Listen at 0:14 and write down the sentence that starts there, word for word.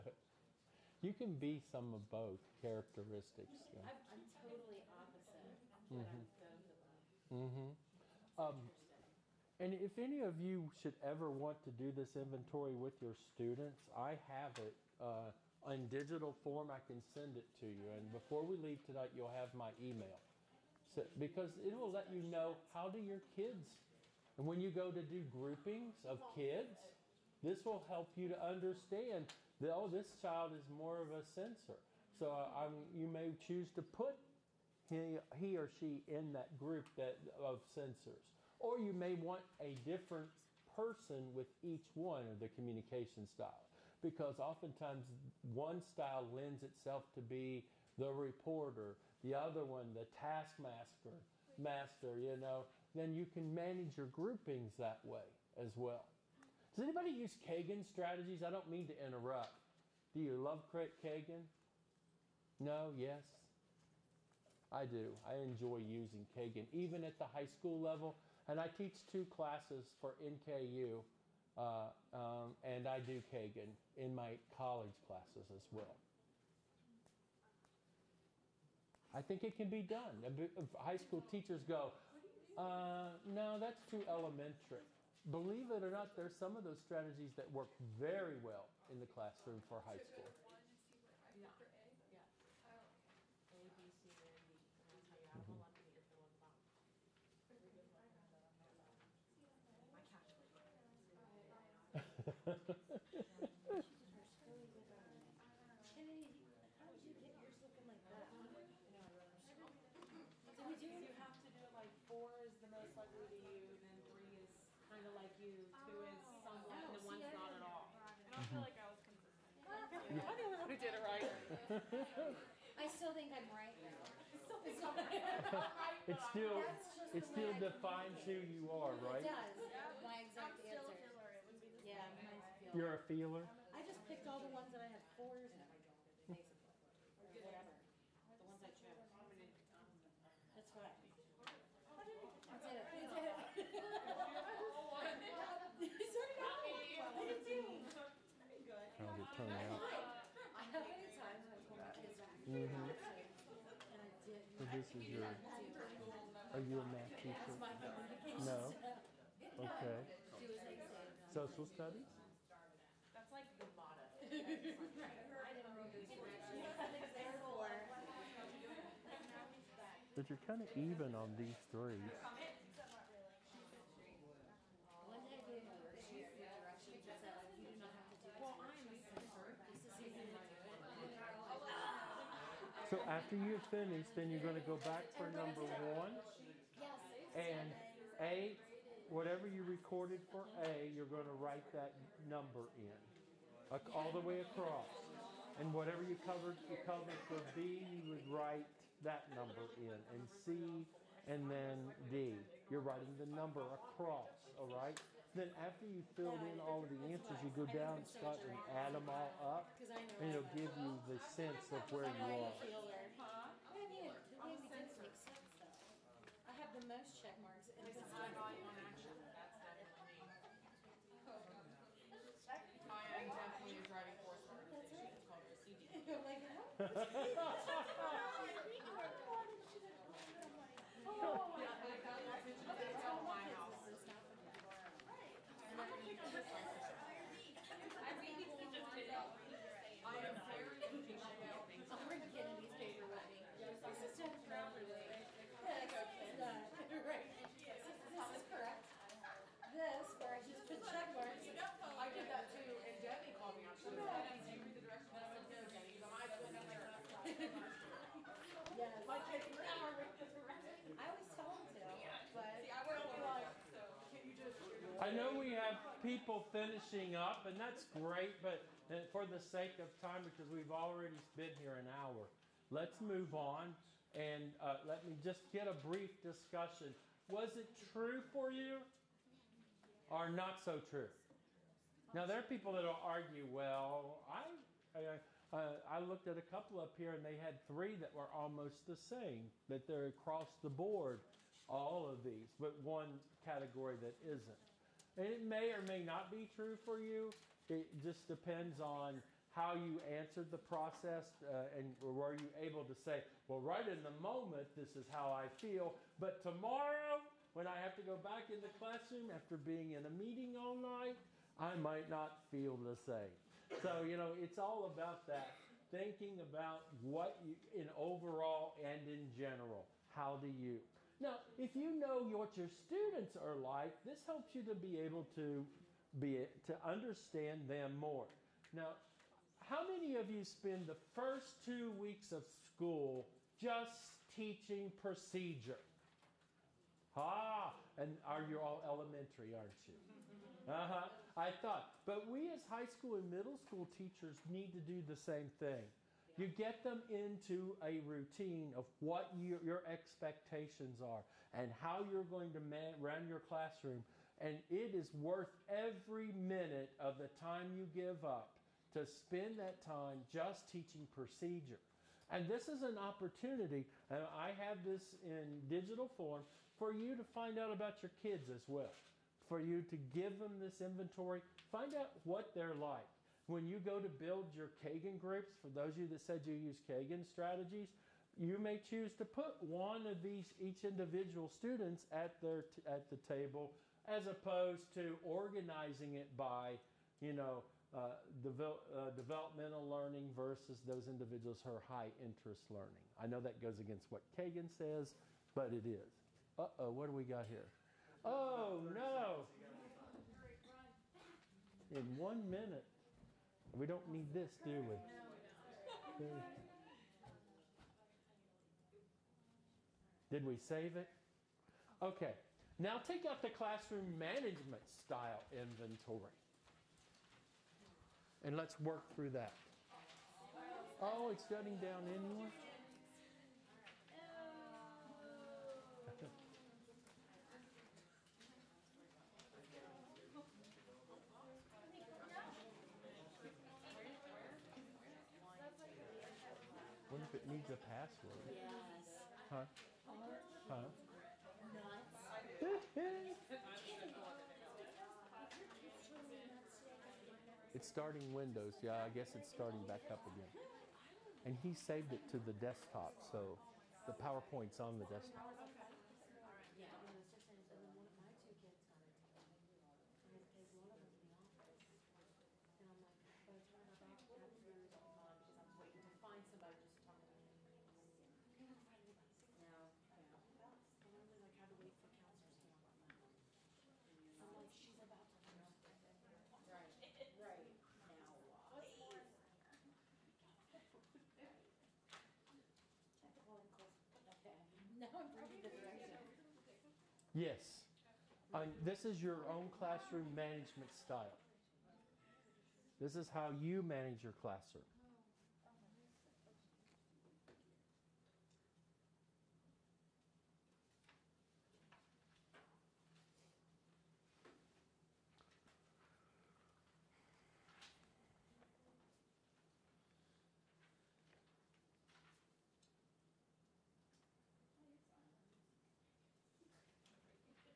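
Uh, in digital form, I can send it to you.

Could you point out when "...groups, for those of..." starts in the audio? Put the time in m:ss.
6:15.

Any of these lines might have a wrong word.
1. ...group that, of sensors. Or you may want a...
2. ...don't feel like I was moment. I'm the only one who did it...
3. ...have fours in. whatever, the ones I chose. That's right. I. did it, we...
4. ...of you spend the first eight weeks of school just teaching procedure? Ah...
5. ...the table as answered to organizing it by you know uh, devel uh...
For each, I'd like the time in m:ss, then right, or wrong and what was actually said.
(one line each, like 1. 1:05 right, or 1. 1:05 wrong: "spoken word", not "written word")
1. 0:36 right
2. 1:58 wrong: "consistent", not "moment"
3. 2:14 right
4. 5:30 wrong: "two", not "eight"
5. 6:23 wrong: "opposed", not "answered".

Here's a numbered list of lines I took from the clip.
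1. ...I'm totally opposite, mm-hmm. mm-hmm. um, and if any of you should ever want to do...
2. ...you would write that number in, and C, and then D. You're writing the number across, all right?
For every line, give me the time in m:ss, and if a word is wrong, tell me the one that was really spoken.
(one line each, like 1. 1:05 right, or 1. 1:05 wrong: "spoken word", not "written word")
1. 0:04 right
2. 3:17 right.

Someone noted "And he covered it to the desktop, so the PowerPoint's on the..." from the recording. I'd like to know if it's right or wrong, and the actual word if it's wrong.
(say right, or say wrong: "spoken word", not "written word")
wrong: "saved", not "covered".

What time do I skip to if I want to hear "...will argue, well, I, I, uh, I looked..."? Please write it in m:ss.
4:42.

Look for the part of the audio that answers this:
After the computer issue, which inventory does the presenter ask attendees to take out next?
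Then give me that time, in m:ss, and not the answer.
6:53.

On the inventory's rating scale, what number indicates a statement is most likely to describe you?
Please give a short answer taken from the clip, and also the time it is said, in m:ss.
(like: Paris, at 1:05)
4, at 1:52.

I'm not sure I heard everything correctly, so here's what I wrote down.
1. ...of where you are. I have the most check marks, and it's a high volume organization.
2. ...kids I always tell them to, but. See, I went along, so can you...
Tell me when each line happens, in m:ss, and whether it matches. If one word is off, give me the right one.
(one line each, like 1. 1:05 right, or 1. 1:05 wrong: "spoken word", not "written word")
1. 3:31 wrong: "action", not "organization"
2. 4:19 right.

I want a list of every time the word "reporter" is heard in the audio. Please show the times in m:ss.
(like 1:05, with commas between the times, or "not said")
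0:48.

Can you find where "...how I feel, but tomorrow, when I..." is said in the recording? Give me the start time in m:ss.
5:05.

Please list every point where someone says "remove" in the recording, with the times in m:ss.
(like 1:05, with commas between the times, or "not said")
not said.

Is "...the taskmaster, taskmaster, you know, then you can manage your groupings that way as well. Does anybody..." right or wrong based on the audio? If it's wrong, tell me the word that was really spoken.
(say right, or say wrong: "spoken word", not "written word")
wrong: "master", not "taskmaster".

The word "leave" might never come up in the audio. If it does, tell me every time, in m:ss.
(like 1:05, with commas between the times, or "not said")
0:18.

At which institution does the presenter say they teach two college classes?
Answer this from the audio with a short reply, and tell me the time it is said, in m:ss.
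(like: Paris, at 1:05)
NKU, at 1:10.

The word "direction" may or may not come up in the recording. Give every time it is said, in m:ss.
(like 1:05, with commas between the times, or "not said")
4:14, 8:05.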